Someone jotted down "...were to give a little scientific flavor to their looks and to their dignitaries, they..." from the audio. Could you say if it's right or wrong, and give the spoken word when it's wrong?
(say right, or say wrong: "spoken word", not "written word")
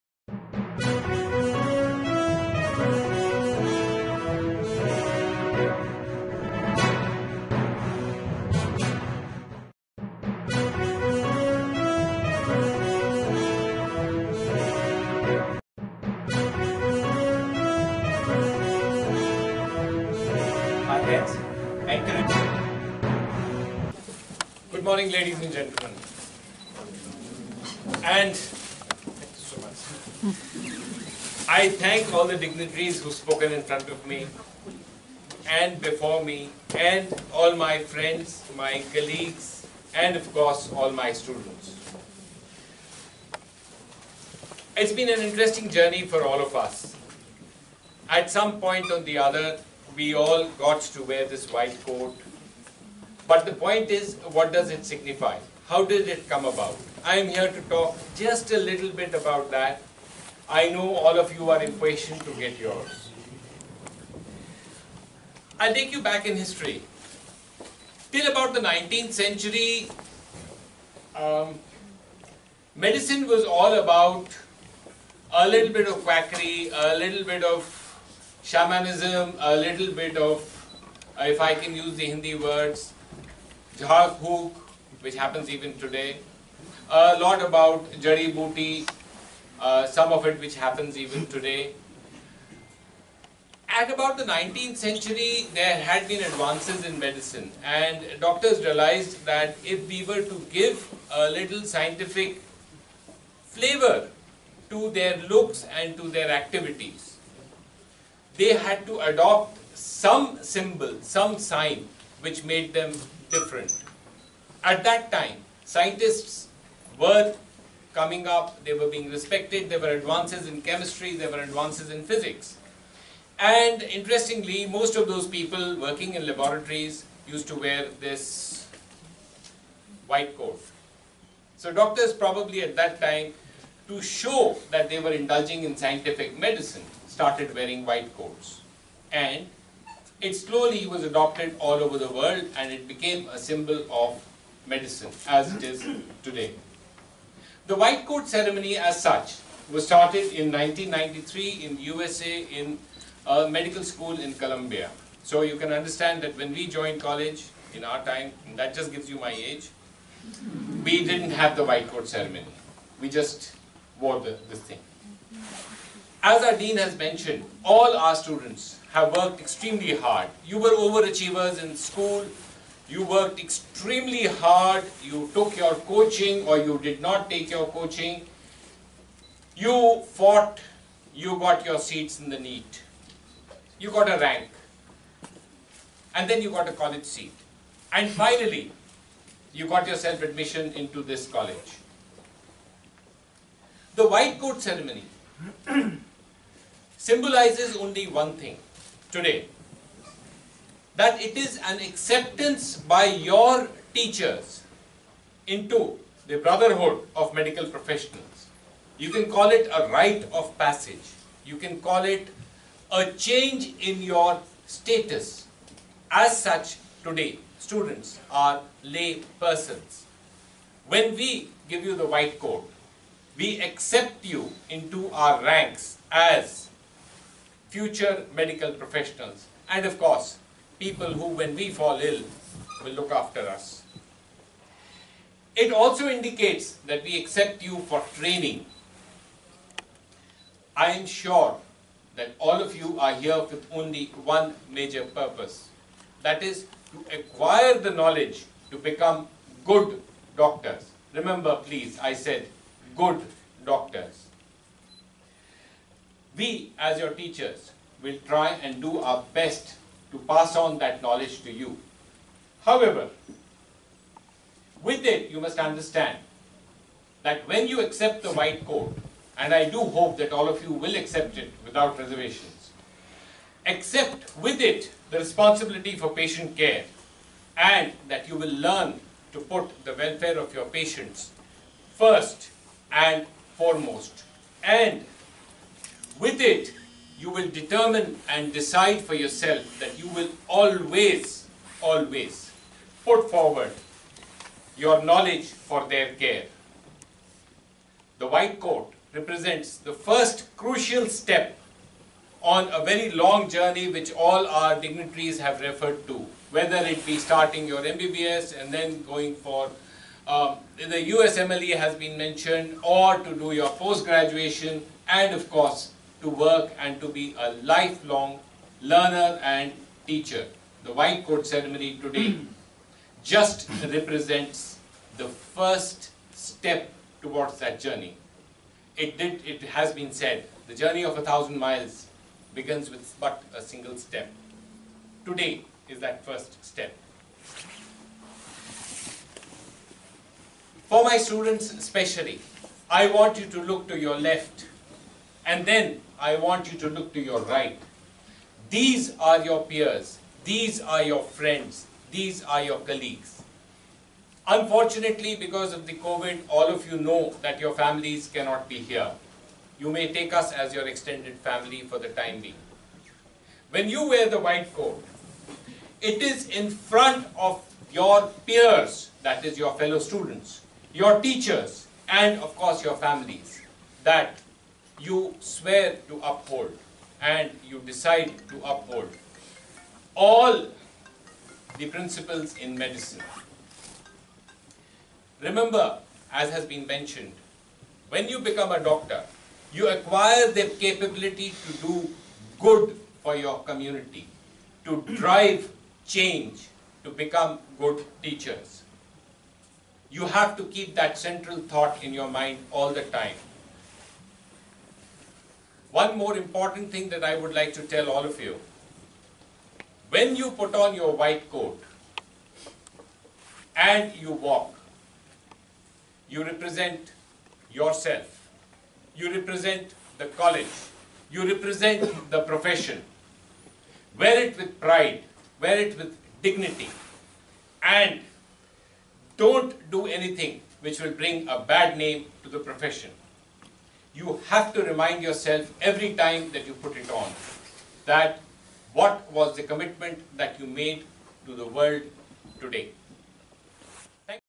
wrong: "activities", not "dignitaries".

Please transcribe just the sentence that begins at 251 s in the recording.
Remember, please, I said good doctors.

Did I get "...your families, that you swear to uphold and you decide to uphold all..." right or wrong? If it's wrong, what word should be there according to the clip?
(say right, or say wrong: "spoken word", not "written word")
right.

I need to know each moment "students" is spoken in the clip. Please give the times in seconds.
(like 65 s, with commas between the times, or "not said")
41 s, 168 s, 217 s, 341 s, 369 s.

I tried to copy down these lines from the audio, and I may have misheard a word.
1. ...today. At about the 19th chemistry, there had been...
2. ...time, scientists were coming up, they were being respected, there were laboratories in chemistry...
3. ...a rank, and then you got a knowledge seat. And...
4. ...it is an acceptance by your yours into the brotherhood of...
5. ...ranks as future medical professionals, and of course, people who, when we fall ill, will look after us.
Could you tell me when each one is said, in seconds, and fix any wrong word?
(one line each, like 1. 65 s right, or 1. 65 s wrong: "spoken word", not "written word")
1. 91 s wrong: "century", not "chemistry"
2. 115 s wrong: "advances", not "laboratories"
3. 184 s wrong: "college", not "knowledge"
4. 201 s wrong: "teachers", not "yours"
5. 225 s right.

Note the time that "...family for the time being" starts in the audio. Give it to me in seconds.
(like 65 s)
361 s.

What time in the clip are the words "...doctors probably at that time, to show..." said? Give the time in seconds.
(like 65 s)
131 s.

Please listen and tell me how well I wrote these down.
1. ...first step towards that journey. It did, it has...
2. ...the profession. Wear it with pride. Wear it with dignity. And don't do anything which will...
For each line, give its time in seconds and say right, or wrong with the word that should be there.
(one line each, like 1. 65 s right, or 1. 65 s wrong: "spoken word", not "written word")
1. 325 s right
2. 422 s right.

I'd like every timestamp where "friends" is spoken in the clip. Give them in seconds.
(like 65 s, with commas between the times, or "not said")
37 s, 351 s.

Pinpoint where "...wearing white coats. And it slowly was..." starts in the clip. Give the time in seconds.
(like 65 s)
137 s.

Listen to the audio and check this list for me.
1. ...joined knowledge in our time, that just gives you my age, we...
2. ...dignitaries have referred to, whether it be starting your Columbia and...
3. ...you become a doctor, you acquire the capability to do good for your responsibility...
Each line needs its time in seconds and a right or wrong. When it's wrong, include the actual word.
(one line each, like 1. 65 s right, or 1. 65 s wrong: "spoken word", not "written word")
1. 156 s wrong: "college", not "knowledge"
2. 304 s wrong: "MBBS", not "Columbia"
3. 388 s wrong: "community", not "responsibility".